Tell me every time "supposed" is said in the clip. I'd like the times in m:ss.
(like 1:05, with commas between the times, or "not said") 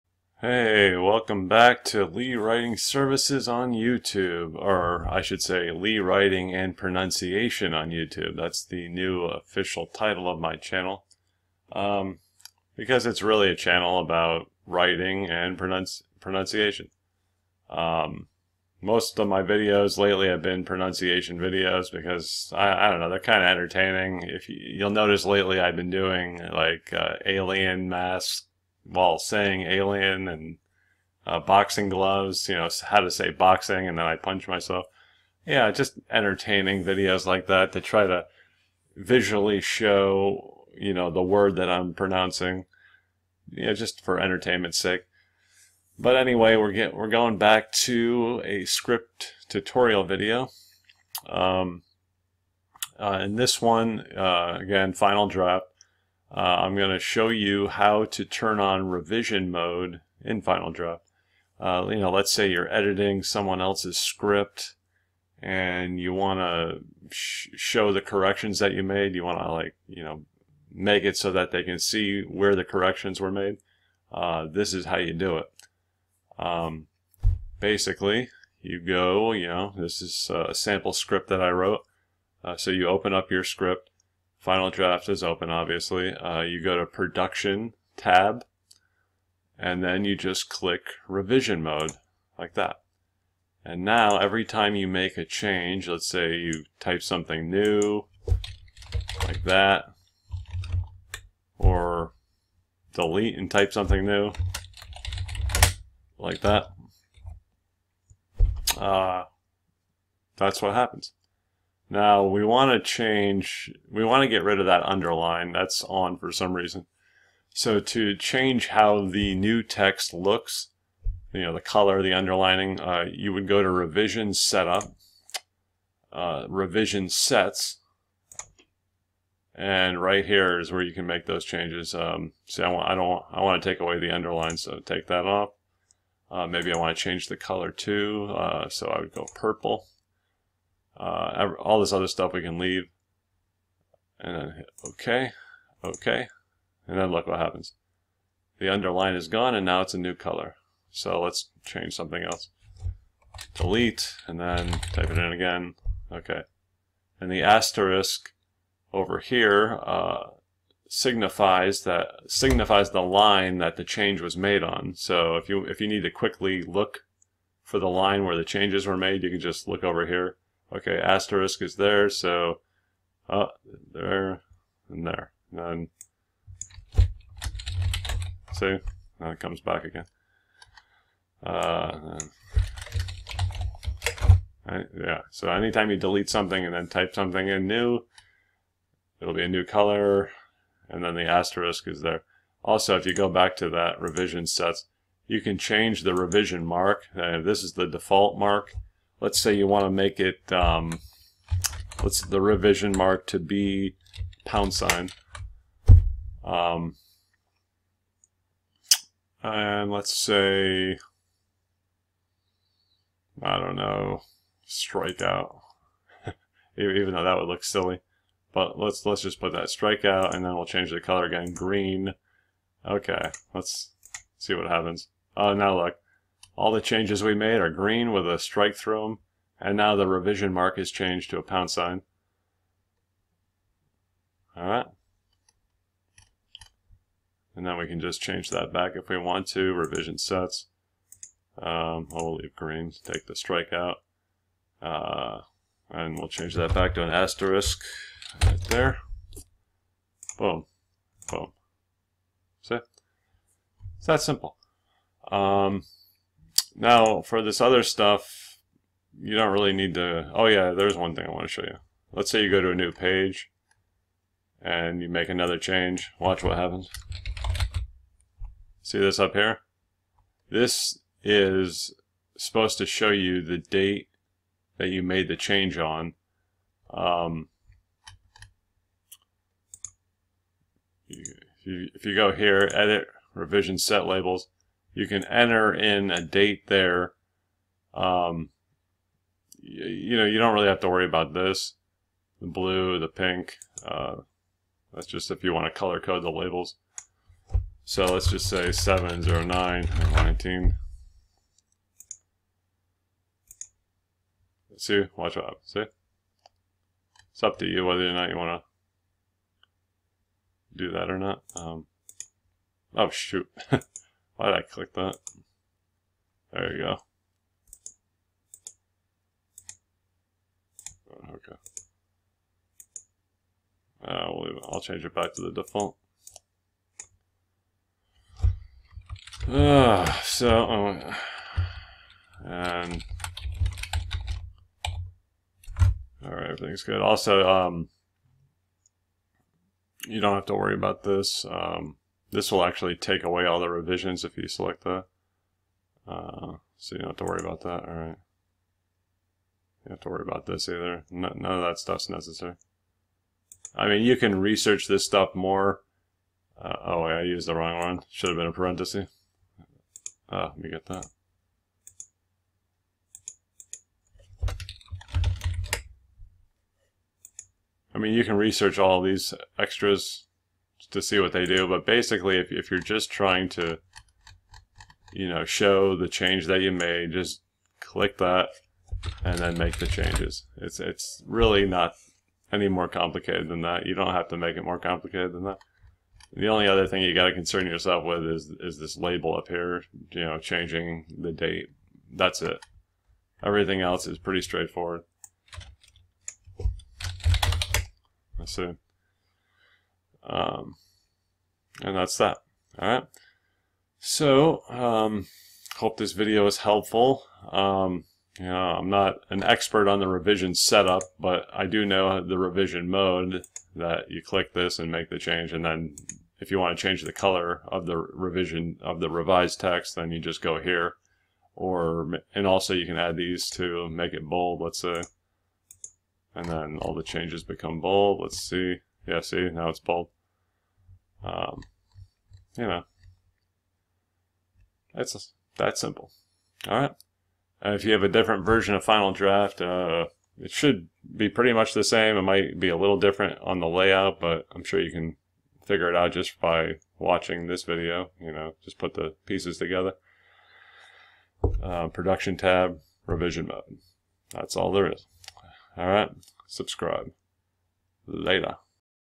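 4:32.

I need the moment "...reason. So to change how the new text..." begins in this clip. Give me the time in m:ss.
1:56.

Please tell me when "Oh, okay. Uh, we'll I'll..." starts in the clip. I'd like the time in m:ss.
5:21.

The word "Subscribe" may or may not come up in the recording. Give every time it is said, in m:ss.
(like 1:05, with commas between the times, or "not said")
7:36.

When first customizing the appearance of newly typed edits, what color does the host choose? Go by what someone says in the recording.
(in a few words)
purple.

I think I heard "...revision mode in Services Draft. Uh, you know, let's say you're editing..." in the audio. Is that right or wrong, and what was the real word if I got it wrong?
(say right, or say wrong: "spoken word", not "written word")
wrong: "Final", not "Services".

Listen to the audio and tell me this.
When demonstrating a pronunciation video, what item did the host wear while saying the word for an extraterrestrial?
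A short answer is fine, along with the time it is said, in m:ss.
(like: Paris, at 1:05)
alien masks, at 0:27.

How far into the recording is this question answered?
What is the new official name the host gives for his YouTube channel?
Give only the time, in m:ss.
0:05.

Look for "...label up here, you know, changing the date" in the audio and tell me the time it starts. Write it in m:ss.
6:28.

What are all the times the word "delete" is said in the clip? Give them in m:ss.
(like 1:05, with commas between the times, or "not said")
1:42, 2:33, 3:05.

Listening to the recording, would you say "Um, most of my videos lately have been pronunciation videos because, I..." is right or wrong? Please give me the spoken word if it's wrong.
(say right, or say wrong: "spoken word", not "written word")
right.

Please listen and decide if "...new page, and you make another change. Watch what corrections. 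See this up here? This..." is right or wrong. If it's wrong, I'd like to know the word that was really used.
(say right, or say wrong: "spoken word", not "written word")
wrong: "happens", not "corrections".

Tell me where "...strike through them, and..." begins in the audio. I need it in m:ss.
3:48.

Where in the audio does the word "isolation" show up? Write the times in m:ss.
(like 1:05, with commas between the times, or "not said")
not said.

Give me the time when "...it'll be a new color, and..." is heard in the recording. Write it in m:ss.
3:09.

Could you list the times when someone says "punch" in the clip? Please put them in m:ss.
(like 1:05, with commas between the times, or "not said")
0:34.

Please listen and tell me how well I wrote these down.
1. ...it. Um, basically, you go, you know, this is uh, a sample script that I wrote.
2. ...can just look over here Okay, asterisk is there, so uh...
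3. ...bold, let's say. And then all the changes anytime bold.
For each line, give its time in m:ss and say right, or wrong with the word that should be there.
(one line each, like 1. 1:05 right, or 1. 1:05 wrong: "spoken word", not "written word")
1. 1:15 right
2. 2:49 right
3. 7:04 wrong: "become", not "anytime".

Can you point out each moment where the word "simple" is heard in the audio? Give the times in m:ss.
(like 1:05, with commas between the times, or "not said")
4:14, 7:15.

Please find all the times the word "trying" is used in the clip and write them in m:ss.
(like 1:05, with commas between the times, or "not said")
6:13.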